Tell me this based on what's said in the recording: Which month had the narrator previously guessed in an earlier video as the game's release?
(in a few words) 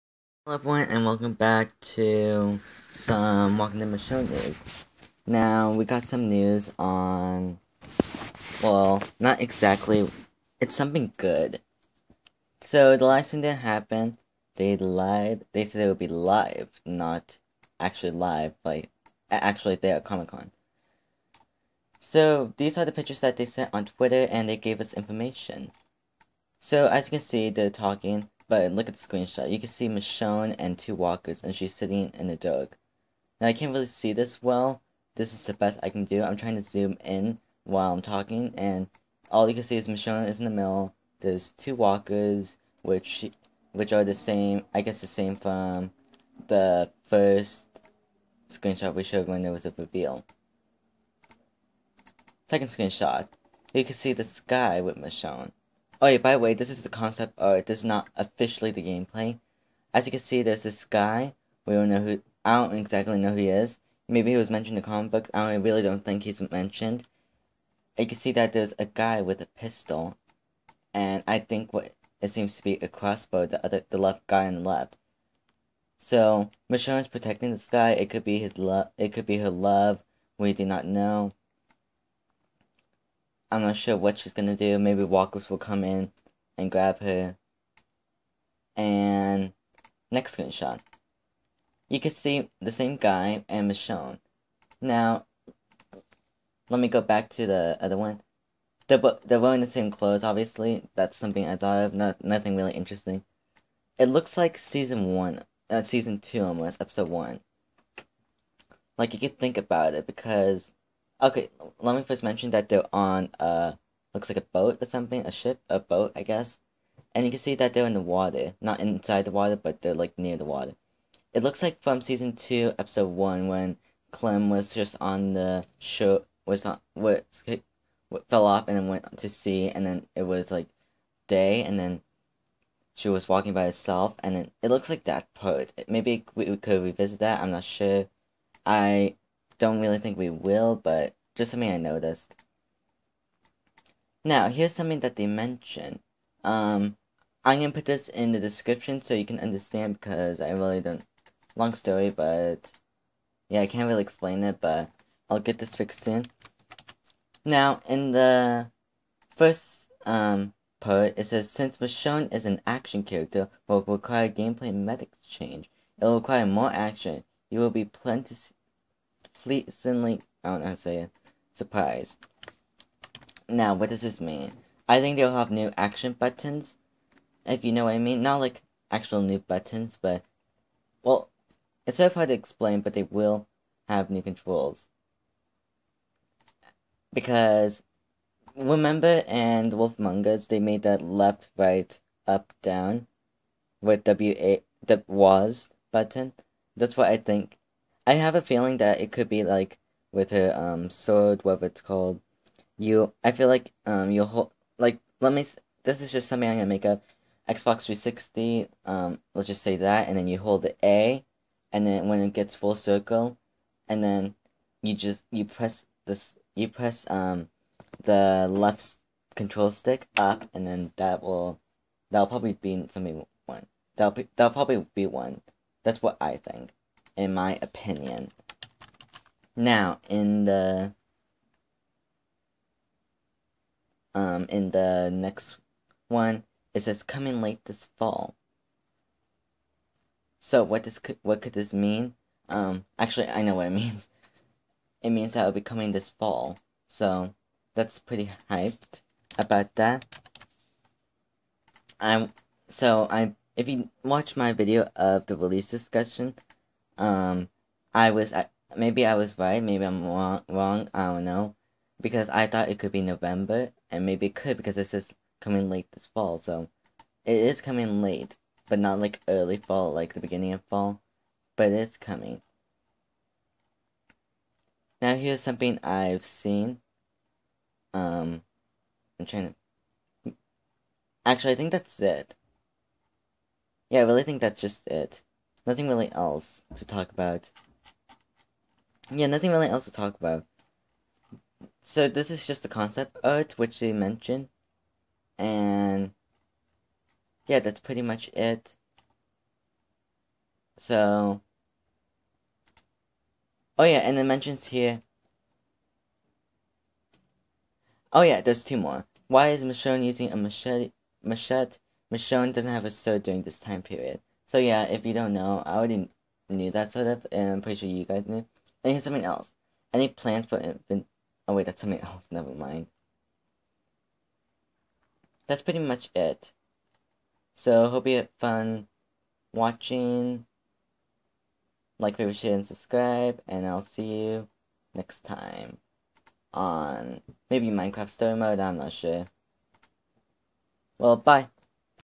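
November.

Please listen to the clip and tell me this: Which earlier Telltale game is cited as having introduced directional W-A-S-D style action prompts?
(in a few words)
Wolf Among Us.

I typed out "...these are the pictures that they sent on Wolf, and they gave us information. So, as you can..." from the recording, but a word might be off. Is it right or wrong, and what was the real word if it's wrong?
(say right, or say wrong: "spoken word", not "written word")
wrong: "Twitter", not "Wolf".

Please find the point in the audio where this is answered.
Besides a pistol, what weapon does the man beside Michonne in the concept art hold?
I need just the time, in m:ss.
1:12.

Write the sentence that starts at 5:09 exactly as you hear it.
Why is Michonne using a machete machete?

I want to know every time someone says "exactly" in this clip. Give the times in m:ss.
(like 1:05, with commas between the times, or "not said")
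0:09, 1:02.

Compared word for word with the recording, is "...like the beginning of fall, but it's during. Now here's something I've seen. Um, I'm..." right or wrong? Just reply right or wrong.
wrong.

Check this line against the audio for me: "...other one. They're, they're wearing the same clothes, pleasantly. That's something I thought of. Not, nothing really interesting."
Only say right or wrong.
wrong.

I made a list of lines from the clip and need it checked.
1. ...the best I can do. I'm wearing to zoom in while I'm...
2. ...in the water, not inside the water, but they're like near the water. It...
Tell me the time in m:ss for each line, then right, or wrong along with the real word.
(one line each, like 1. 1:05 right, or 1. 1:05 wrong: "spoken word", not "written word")
1. 0:35 wrong: "trying", not "wearing"
2. 1:57 right.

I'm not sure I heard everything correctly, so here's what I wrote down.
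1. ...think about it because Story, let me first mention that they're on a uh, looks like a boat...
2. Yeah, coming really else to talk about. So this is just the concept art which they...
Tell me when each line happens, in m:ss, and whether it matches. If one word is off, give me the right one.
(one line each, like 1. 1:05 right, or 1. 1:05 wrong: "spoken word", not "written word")
1. 1:49 wrong: "Okay", not "Story"
2. 4:49 wrong: "nothing", not "coming".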